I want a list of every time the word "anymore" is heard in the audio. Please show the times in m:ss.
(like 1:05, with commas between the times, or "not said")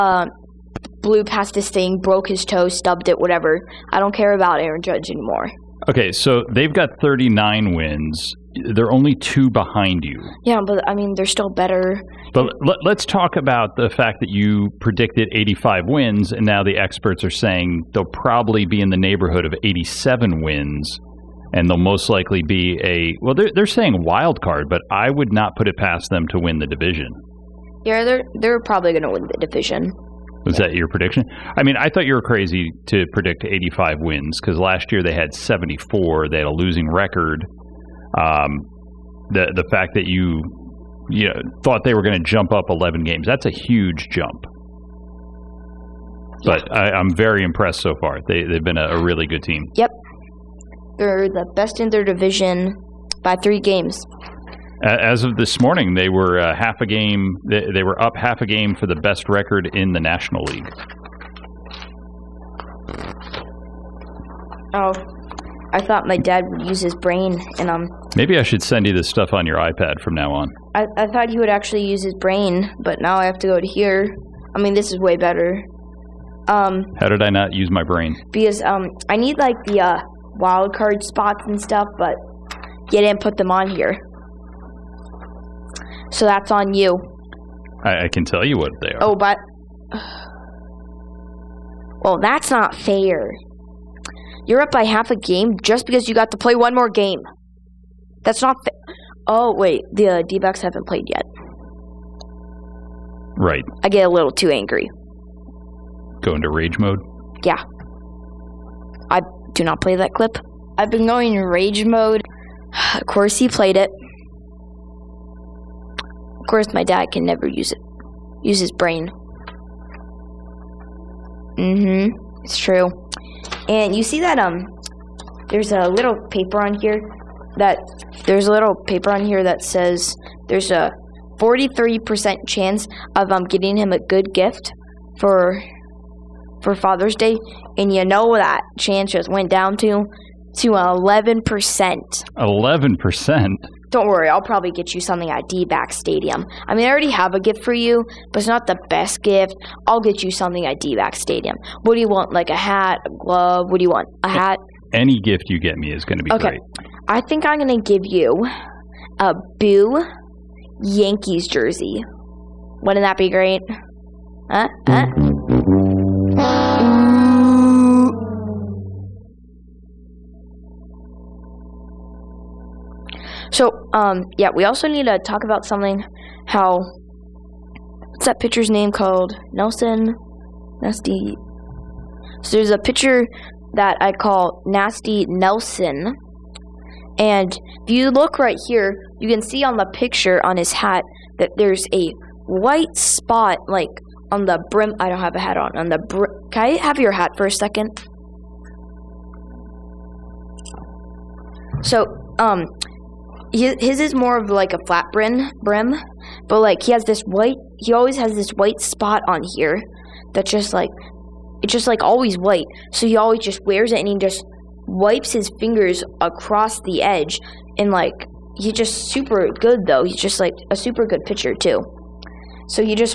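0:05.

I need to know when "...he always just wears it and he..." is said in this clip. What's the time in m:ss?
3:33.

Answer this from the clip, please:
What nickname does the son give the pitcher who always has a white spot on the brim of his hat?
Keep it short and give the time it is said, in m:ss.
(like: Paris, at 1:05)
Nasty Nelson, at 3:04.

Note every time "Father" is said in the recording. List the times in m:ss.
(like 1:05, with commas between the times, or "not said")
2:16.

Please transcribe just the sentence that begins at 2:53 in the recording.
So, um, yeah, we also need to talk about something.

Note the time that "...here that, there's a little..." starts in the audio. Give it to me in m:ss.
2:06.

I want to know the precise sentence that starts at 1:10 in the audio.
I, I thought he would actually use his brain, but now I have to go to here.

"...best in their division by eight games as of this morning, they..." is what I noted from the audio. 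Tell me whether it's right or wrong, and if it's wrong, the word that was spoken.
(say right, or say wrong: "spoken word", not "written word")
wrong: "three", not "eight".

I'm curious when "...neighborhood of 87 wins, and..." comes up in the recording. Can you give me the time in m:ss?
0:18.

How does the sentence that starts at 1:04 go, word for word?
Oh, I thought my dad would use his brain, and um.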